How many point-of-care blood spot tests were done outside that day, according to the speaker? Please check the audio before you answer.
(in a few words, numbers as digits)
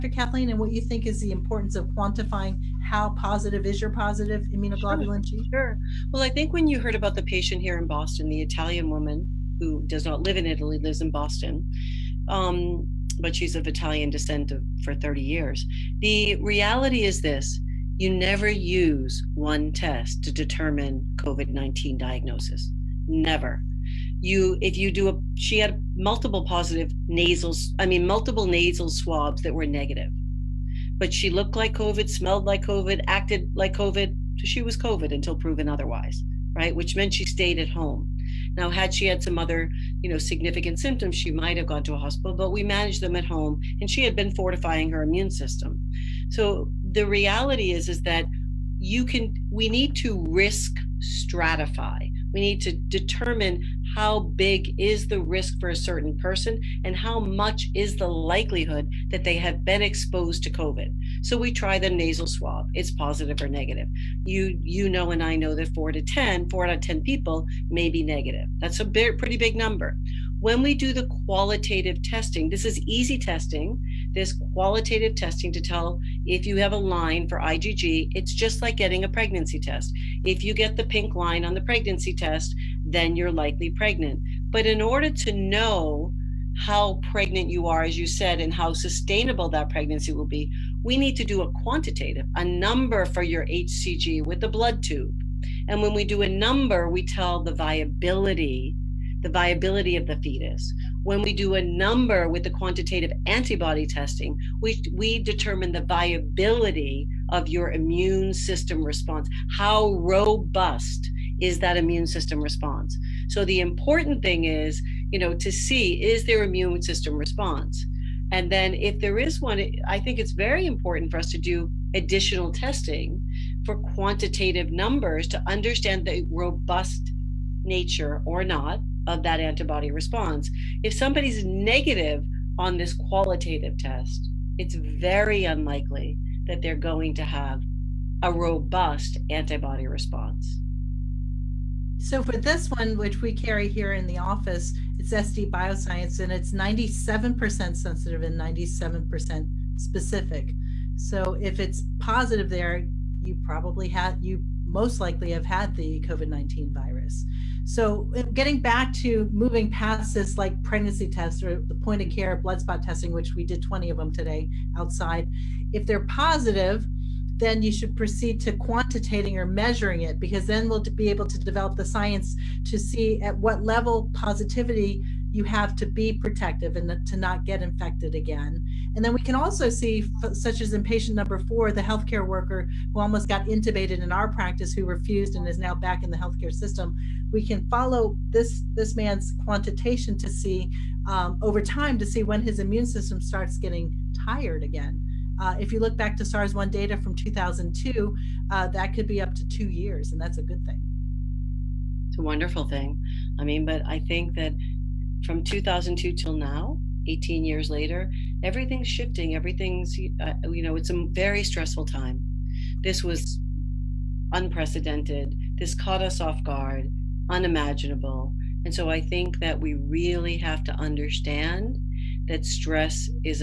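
20.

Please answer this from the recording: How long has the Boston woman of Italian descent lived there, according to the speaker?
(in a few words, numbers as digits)
30 years.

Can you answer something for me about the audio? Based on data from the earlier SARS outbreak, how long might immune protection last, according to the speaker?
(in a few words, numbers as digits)
up to 2 years.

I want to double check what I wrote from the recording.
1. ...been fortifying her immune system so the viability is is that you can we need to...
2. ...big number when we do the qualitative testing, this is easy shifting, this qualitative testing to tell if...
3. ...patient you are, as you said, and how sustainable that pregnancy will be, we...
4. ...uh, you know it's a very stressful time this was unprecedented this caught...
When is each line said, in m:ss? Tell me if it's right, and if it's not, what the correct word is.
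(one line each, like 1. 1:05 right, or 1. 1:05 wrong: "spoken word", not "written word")
1. 0:44 wrong: "reality", not "viability"
2. 1:09 wrong: "testing", not "shifting"
3. 1:27 wrong: "pregnant", not "patient"
4. 3:30 right.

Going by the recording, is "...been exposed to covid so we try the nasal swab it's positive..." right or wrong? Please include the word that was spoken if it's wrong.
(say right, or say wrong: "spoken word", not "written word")
right.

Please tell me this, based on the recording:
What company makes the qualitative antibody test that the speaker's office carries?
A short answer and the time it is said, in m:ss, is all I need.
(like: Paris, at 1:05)
SD Bioscience, at 2:25.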